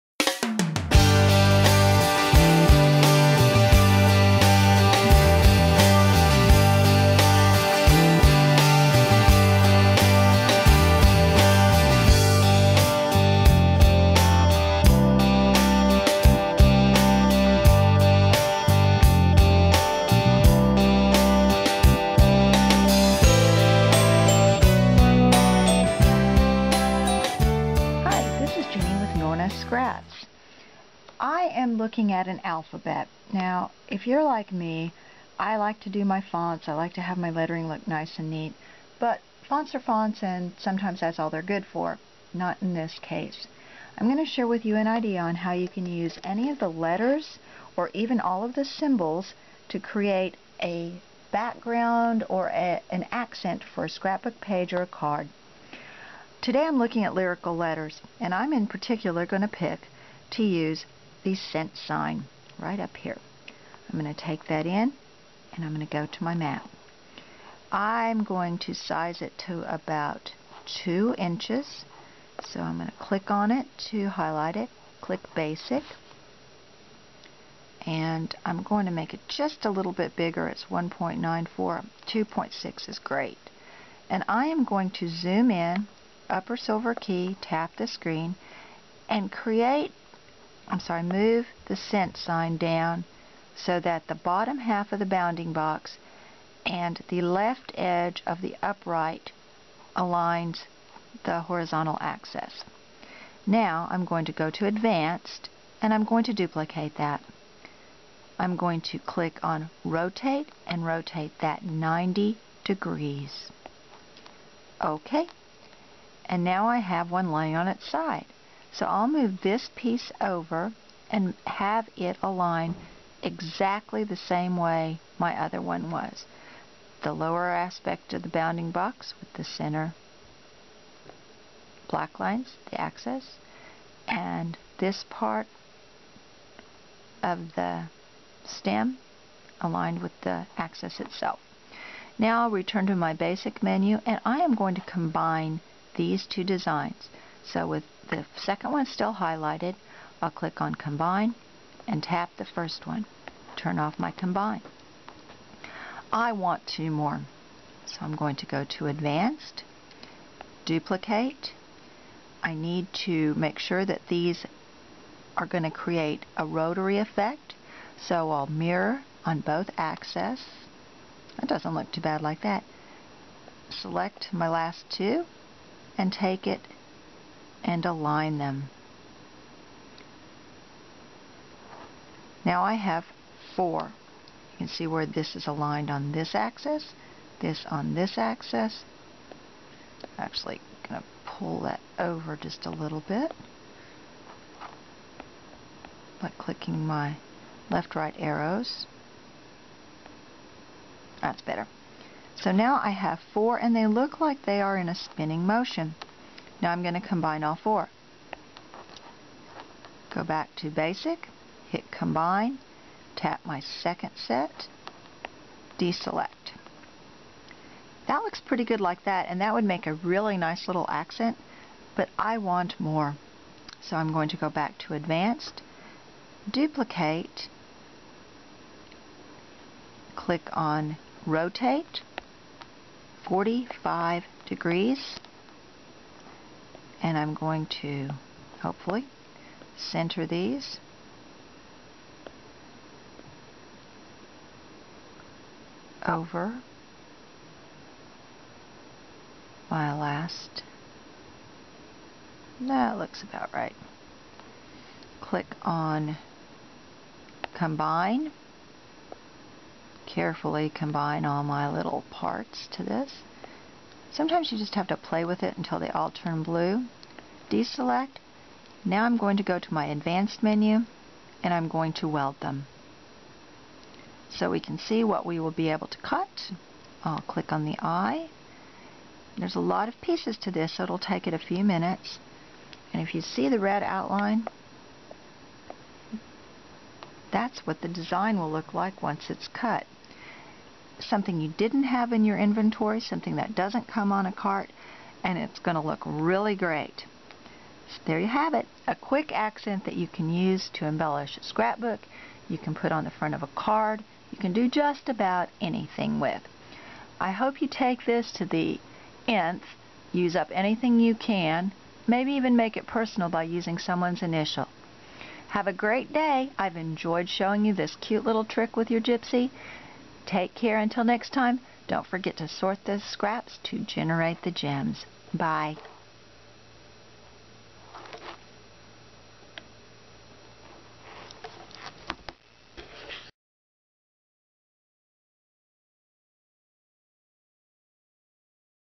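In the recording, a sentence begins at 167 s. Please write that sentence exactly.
So I'll mirror on both axes.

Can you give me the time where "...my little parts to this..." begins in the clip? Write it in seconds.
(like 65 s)
261 s.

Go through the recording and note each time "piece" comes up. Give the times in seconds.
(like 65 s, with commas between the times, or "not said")
119 s, 280 s.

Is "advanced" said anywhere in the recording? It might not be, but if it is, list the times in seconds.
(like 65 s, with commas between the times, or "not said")
104 s, 158 s, 224 s, 269 s.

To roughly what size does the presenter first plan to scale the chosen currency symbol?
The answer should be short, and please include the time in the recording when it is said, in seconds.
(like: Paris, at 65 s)
2 inches, at 70 s.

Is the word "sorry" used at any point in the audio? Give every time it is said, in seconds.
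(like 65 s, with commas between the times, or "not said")
90 s.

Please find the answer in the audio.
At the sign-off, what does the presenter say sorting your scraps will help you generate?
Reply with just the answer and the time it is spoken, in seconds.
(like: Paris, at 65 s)
gems, at 324 s.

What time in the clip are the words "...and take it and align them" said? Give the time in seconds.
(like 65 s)
175 s.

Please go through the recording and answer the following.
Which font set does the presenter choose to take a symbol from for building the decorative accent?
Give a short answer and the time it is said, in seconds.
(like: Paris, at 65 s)
Lyrical Letters, at 57 s.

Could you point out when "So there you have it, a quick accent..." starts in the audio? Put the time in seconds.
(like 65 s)
297 s.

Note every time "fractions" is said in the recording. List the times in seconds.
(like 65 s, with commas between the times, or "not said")
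not said.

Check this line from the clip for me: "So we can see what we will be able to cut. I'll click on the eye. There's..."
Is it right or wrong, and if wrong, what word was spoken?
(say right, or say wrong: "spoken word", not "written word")
right.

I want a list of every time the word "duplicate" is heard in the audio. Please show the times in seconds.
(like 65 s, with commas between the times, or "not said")
106 s, 160 s, 226 s.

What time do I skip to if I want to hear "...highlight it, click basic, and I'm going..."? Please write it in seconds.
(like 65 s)
74 s.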